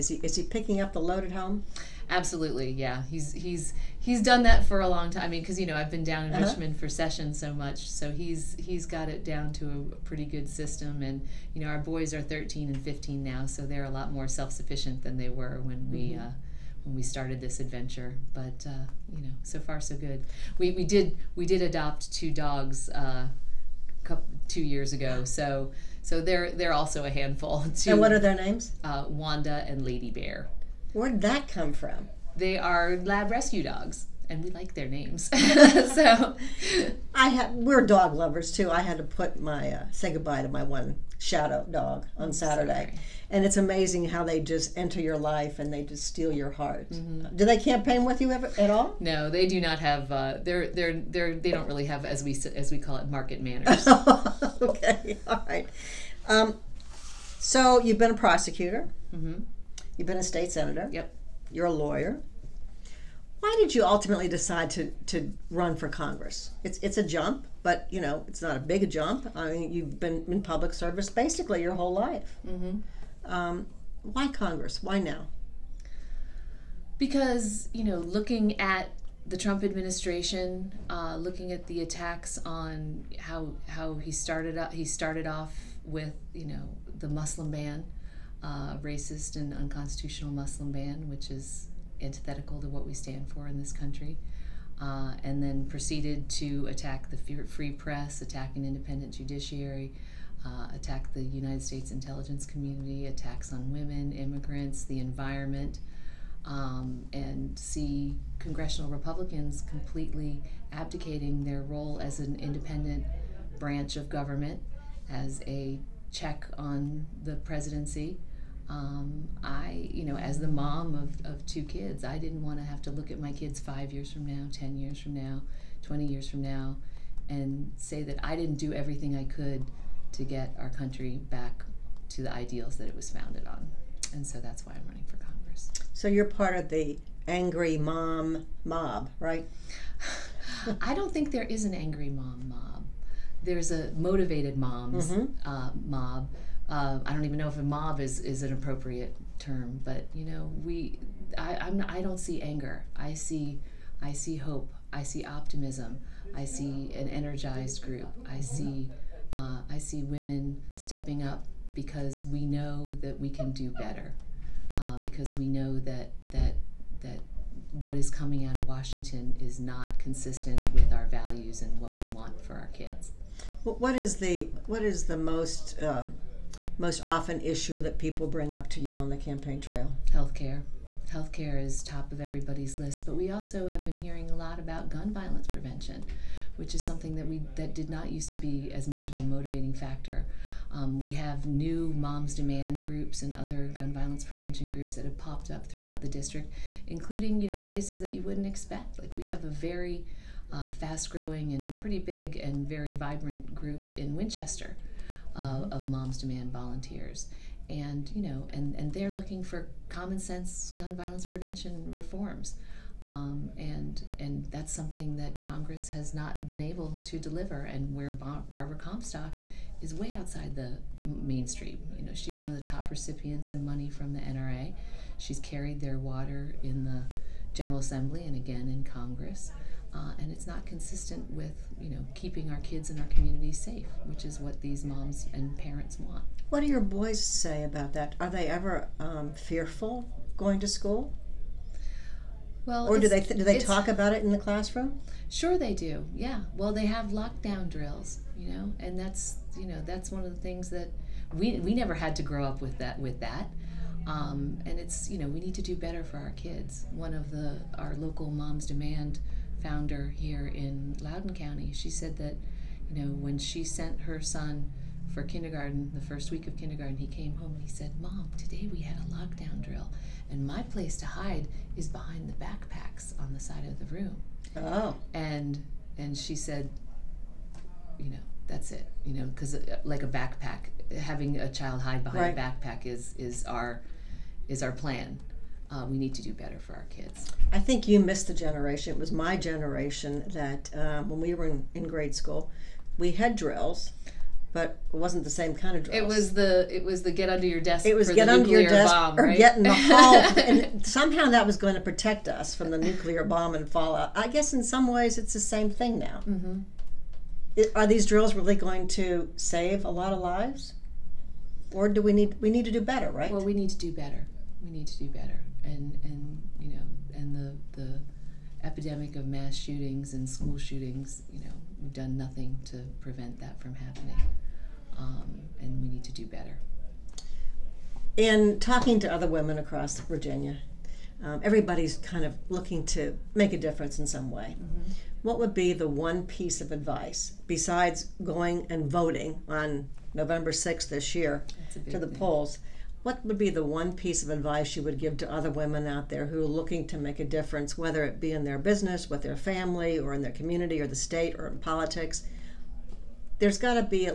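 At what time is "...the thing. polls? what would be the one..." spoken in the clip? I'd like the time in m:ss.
5:41.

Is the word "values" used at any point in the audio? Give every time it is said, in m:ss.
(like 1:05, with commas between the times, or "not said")
2:51.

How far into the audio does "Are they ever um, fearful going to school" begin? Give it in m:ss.
3:58.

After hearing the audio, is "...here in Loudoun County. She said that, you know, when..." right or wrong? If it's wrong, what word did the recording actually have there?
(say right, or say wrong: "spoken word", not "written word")
right.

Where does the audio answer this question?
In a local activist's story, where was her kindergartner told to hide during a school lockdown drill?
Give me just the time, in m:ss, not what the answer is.
4:31.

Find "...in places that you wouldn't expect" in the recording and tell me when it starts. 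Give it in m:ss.
3:17.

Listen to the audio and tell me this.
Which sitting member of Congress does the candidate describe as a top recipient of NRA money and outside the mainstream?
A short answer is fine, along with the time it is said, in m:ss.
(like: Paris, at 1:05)
Barbara Comstock, at 3:38.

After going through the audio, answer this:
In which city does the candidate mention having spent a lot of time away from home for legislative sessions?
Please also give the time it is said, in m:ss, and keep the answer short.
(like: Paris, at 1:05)
Richmond, at 0:06.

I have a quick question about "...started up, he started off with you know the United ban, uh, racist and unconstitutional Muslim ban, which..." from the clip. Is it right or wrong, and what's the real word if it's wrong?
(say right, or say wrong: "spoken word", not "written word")
wrong: "Muslim", not "United".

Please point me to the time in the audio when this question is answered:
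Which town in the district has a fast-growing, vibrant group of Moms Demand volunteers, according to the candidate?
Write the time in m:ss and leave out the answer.
3:24.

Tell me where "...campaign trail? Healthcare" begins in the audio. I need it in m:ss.
2:59.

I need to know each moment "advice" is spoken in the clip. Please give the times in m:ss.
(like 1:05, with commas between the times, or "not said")
5:36, 5:44.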